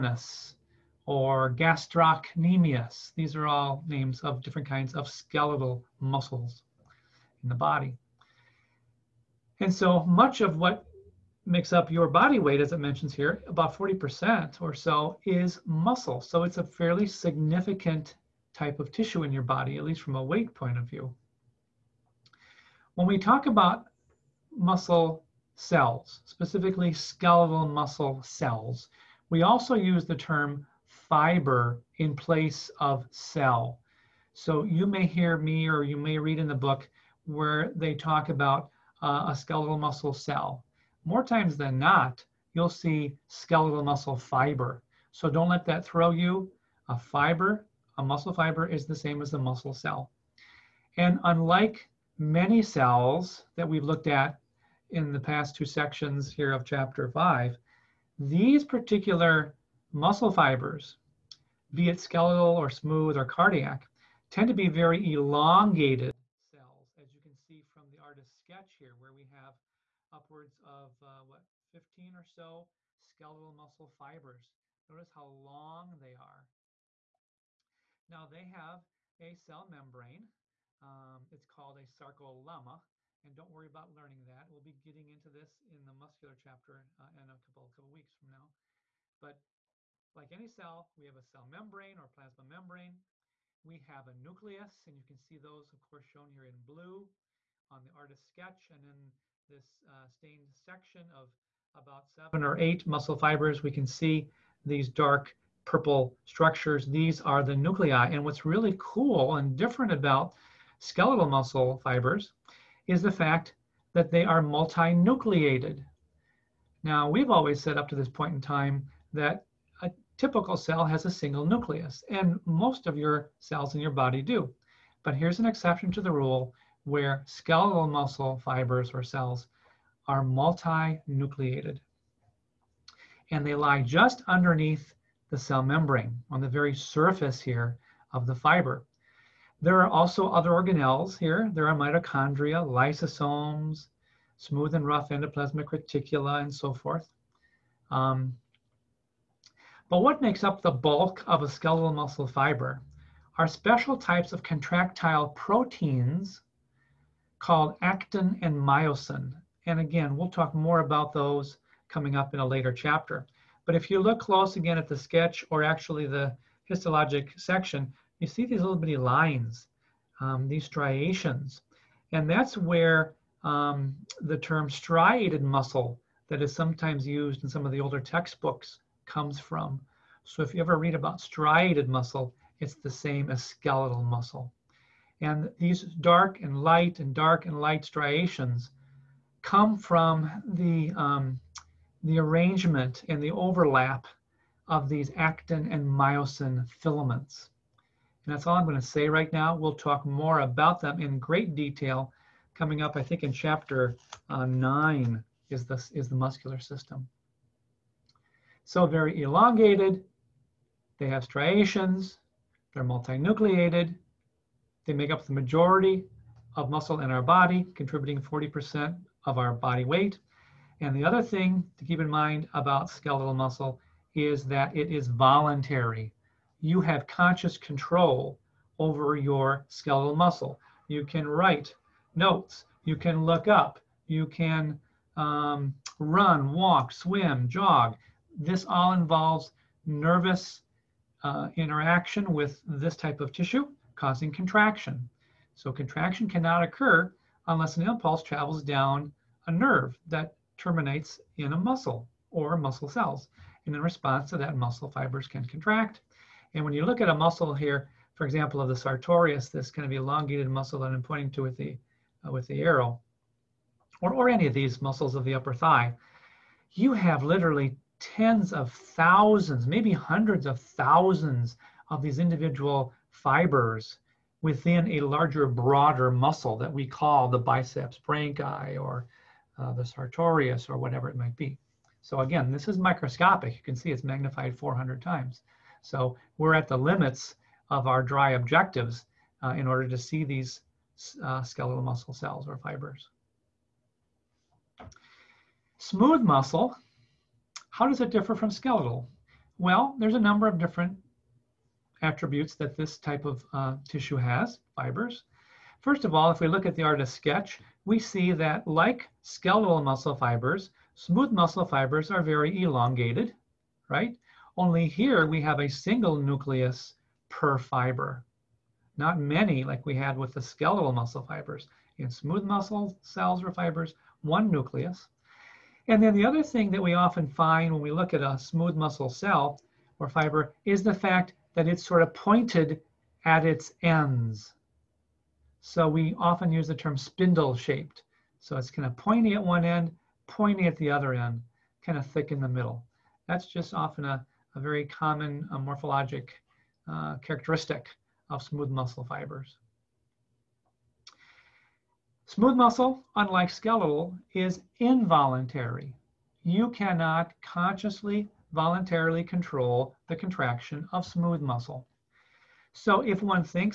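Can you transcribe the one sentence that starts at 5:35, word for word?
So we often use the term spindle shaped.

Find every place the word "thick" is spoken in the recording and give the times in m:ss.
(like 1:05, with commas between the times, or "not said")
5:42.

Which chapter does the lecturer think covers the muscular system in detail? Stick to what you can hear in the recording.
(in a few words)
chapter 9.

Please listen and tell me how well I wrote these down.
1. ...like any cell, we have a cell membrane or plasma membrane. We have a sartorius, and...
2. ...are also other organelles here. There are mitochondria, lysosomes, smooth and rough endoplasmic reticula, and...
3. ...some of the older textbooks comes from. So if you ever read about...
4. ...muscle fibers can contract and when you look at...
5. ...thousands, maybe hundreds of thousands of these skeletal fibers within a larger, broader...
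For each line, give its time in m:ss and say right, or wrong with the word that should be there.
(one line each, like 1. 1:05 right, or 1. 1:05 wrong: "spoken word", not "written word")
1. 1:30 wrong: "nucleus", not "sartorius"
2. 2:19 right
3. 2:57 right
4. 4:14 right
5. 4:28 wrong: "individual", not "skeletal".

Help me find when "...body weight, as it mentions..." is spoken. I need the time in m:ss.
0:12.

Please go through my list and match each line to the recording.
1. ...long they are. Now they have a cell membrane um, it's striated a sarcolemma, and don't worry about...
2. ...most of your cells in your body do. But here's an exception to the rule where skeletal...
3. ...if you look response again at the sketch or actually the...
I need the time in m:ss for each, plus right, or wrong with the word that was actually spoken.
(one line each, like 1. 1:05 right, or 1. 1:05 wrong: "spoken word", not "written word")
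1. 1:15 wrong: "called", not "striated"
2. 2:02 right
3. 2:43 wrong: "close", not "response".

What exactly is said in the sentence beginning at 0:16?
So it's a fairly significant type of tissue in your body, at least from a weight point of view.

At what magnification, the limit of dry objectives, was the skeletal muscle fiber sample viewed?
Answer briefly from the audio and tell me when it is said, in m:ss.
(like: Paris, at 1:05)
400 times, at 4:44.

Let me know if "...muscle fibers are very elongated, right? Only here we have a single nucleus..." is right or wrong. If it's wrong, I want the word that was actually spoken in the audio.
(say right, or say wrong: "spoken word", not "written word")
right.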